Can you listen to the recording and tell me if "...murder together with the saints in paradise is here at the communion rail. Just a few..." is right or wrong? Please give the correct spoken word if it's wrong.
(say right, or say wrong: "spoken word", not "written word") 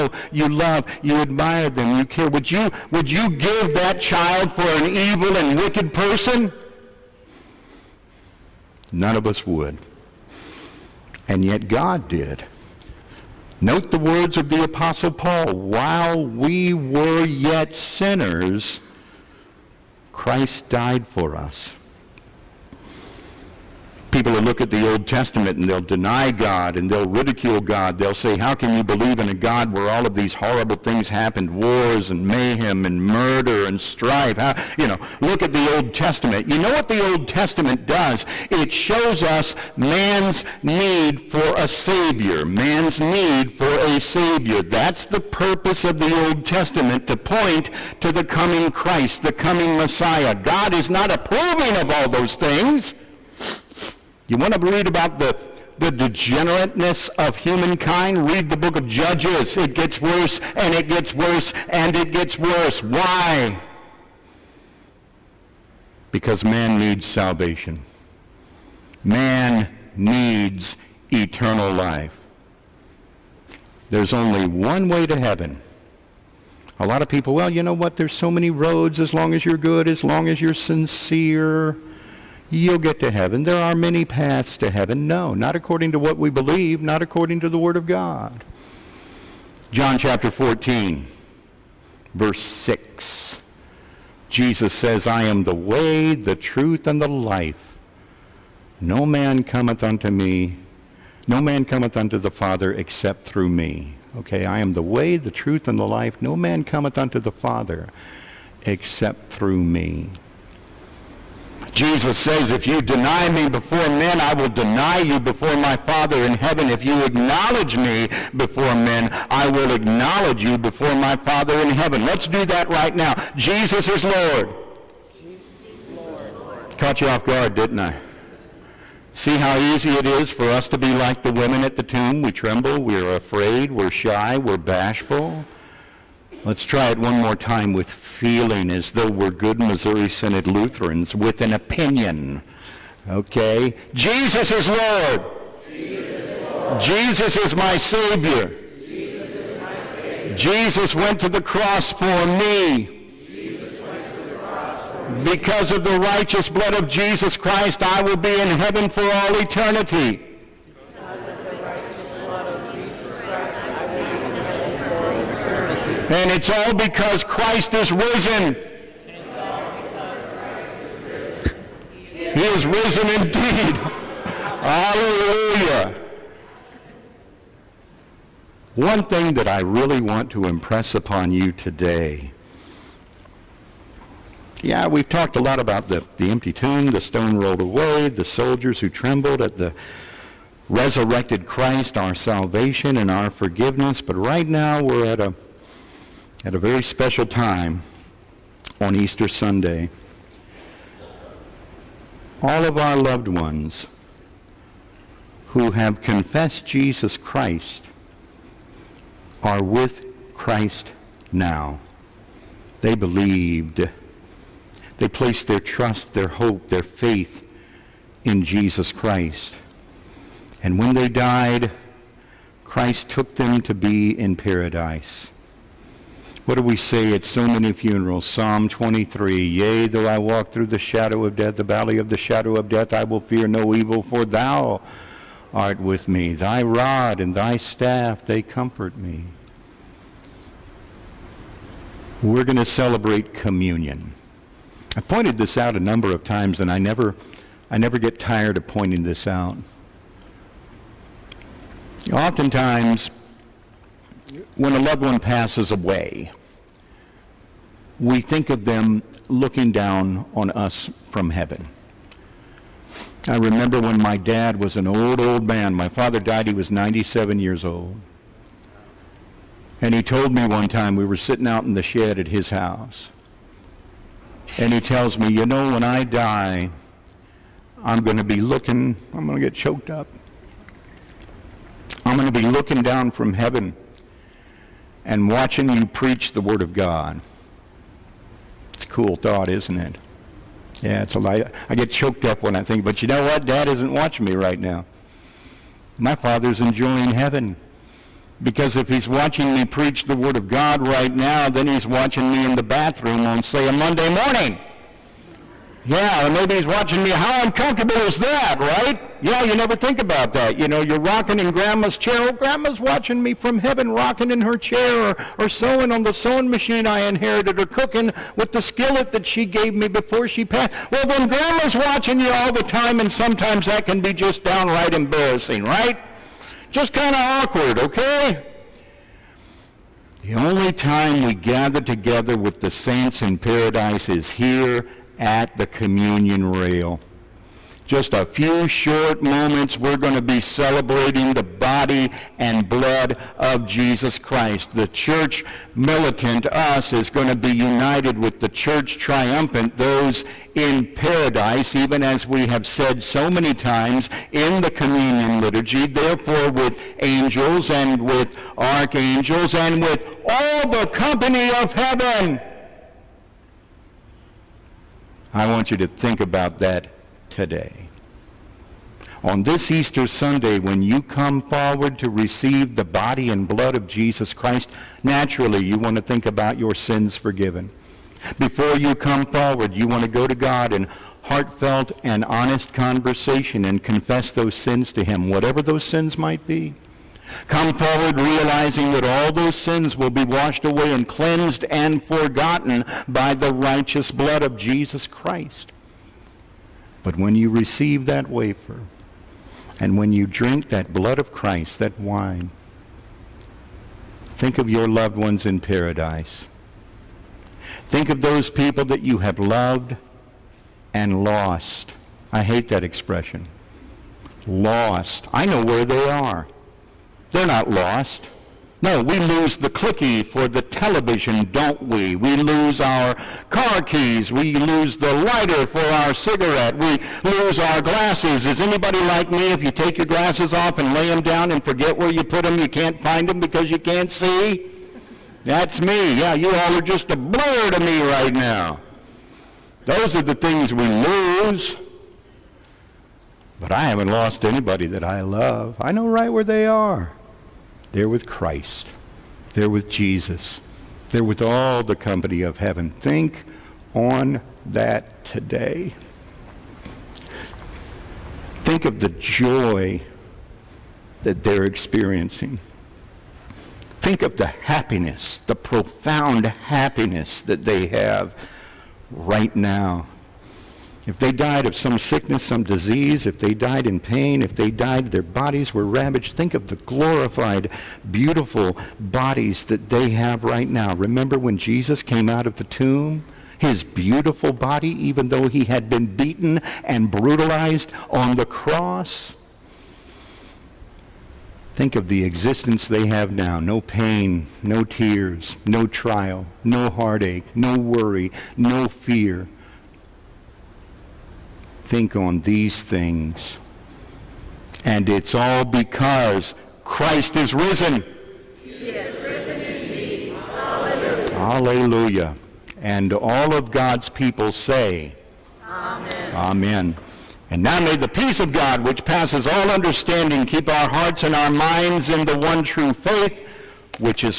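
wrong: "gather", not "murder".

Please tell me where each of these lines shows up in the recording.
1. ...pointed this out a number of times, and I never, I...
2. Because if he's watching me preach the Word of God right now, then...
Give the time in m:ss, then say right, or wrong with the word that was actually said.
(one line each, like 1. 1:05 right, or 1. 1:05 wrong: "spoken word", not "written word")
1. 4:05 right
2. 4:58 right.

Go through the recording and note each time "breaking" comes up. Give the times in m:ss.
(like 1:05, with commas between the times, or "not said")
not said.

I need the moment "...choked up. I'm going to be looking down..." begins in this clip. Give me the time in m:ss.
4:39.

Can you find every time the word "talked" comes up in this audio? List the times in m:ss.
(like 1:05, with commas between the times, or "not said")
3:05.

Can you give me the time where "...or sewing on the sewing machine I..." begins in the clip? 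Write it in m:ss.
5:15.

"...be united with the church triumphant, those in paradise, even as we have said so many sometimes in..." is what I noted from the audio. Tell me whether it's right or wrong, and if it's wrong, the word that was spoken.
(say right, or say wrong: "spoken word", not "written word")
wrong: "times", not "sometimes".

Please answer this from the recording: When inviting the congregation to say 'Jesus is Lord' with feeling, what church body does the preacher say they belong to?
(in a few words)
Missouri Synod Lutherans.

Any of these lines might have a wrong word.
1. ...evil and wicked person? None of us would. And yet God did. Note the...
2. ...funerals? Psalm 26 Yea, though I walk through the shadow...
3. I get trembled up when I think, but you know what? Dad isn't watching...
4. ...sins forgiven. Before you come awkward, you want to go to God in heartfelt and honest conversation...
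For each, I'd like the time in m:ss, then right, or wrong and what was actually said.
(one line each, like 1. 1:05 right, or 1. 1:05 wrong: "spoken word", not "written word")
1. 0:04 right
2. 3:47 wrong: "23", not "26"
3. 4:51 wrong: "choked", not "trembled"
4. 6:16 wrong: "forward", not "awkward".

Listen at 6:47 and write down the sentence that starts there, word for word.
Think of those people that you have loved and lost.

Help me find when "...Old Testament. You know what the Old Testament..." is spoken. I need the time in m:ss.
0:35.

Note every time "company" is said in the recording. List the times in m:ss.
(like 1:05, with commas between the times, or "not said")
6:00, 7:31.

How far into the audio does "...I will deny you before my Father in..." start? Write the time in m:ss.
1:54.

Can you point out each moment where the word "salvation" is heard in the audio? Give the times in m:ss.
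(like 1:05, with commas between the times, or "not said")
1:07, 3:12.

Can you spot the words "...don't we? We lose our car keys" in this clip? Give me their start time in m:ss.
7:01.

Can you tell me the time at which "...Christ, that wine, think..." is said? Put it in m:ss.
6:41.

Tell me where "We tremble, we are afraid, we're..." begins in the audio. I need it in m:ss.
2:12.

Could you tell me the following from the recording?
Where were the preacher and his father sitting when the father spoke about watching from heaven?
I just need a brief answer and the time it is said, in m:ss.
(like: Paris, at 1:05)
In the shed, at 4:31.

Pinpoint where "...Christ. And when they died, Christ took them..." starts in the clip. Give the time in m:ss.
3:38.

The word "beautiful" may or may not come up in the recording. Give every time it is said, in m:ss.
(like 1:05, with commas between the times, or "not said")
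7:58, 8:03.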